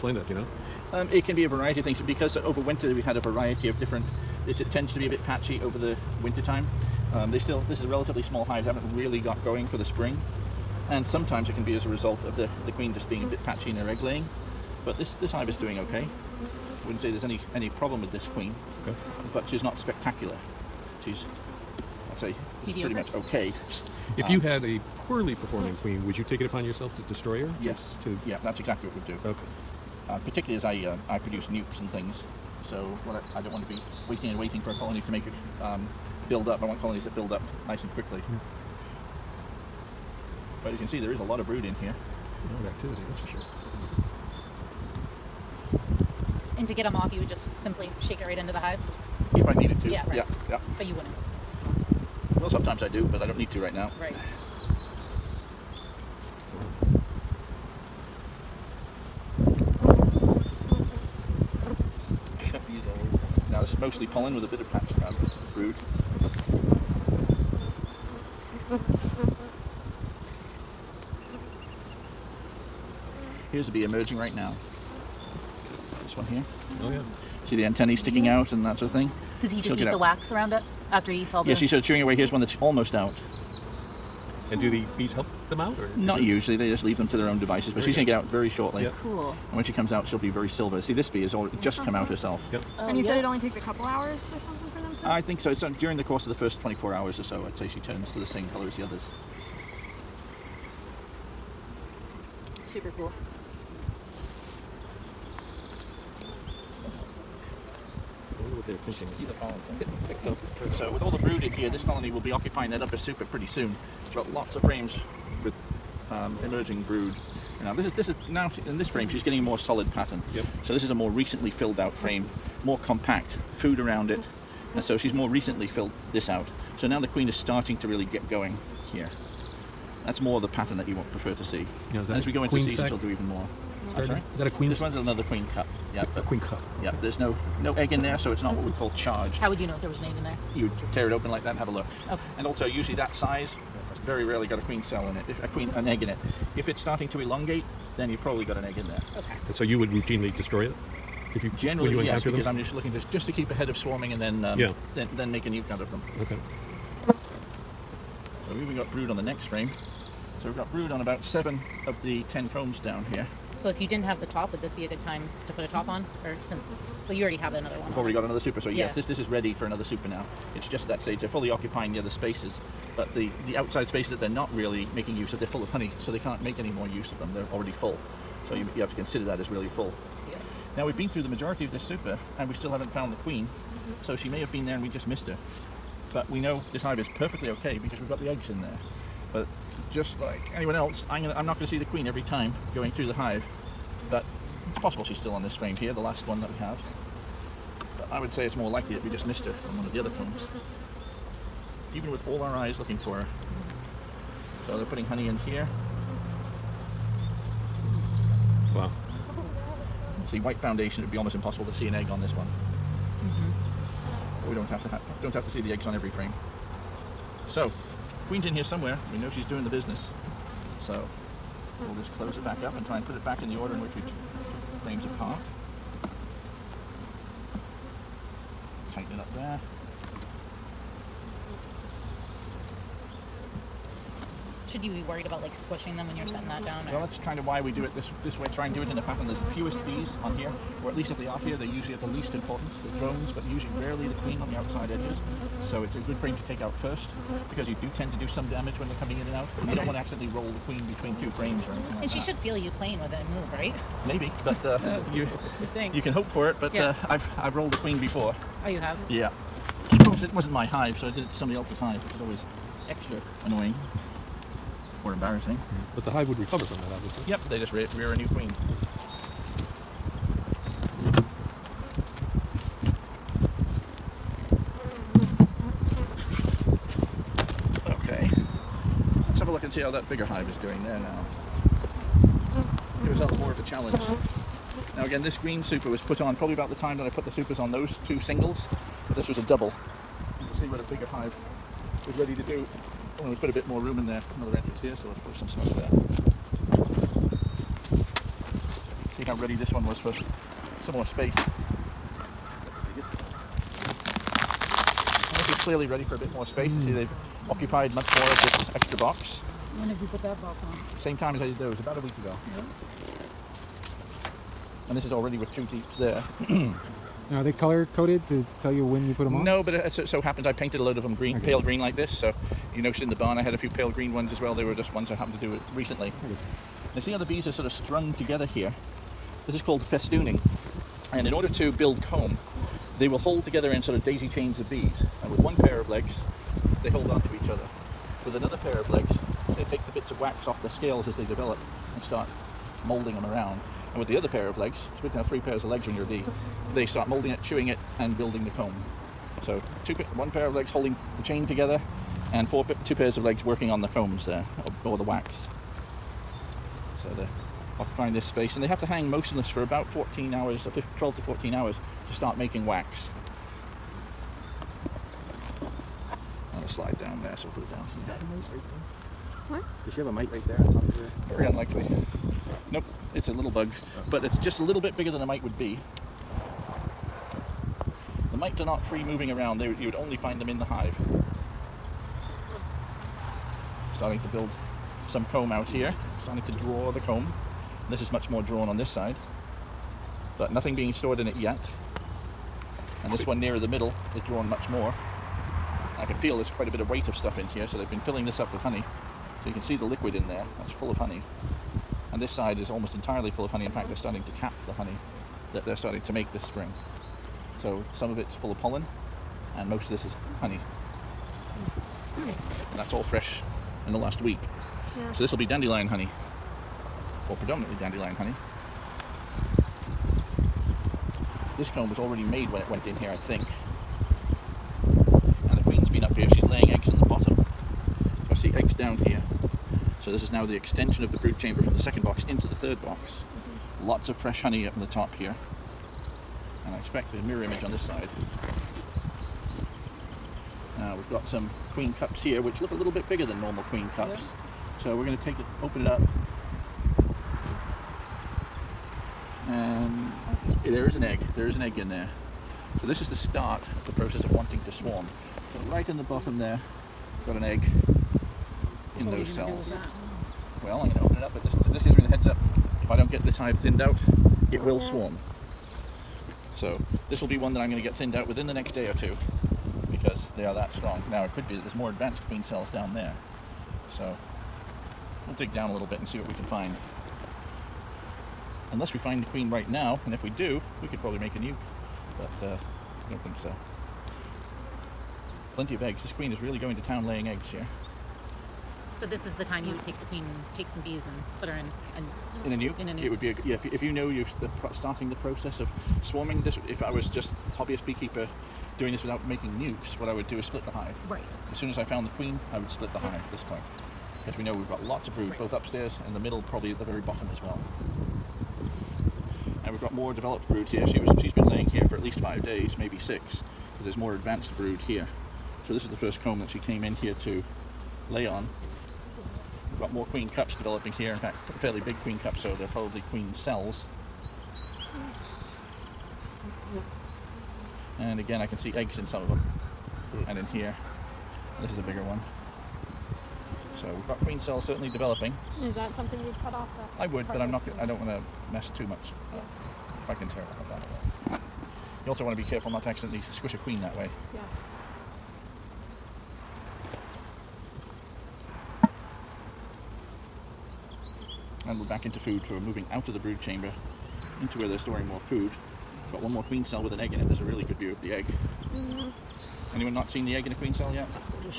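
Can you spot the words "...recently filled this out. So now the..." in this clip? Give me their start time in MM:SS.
02:05.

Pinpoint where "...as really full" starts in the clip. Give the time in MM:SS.
02:59.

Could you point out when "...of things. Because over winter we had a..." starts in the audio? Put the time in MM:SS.
00:01.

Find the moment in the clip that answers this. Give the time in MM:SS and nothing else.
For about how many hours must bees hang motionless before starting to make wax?
06:00.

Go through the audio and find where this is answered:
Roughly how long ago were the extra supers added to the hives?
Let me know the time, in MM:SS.
05:11.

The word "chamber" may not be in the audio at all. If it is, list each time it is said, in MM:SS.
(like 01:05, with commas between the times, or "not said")
07:11, 09:13.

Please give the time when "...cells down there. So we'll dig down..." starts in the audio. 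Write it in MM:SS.
07:52.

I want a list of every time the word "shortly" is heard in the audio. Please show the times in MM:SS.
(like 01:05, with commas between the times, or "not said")
01:28.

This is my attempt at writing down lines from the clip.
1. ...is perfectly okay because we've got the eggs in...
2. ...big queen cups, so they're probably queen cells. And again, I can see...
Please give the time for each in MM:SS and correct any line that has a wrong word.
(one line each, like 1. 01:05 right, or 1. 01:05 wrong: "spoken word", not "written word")
1. 03:06 right
2. 08:41 right.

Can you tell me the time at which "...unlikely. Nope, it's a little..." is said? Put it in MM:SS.
06:11.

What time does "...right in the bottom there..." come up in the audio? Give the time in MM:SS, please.
07:35.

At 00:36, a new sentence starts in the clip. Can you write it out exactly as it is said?
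I want colonies that build up nice and quickly.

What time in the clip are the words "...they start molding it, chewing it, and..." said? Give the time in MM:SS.
05:46.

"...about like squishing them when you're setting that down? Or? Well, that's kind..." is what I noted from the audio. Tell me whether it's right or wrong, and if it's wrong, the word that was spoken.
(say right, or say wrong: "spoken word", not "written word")
right.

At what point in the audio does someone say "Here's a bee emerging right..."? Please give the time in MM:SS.
01:13.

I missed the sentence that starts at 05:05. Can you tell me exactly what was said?
clearly ready for a bit more space.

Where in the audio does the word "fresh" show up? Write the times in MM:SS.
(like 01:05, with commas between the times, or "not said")
06:53, 07:14.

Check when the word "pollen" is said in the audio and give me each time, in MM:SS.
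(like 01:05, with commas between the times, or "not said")
01:04, 01:49, 06:48.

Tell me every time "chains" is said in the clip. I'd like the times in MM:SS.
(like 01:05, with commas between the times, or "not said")
05:34, 05:51.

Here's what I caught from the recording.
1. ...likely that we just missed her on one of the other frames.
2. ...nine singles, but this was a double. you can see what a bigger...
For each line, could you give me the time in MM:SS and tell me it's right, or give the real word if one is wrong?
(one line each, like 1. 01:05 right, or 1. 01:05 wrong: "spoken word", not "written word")
1. 03:18 right
2. 04:48 wrong: "two", not "nine".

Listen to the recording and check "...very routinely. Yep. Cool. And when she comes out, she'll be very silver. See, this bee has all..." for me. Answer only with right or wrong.
wrong.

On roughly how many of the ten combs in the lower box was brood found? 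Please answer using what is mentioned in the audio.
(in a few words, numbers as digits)
7.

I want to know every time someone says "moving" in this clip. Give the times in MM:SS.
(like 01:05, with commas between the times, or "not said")
06:19, 09:12.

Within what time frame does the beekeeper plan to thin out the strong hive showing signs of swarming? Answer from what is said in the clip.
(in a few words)
next day or two.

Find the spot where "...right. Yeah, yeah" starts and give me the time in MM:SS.
00:50.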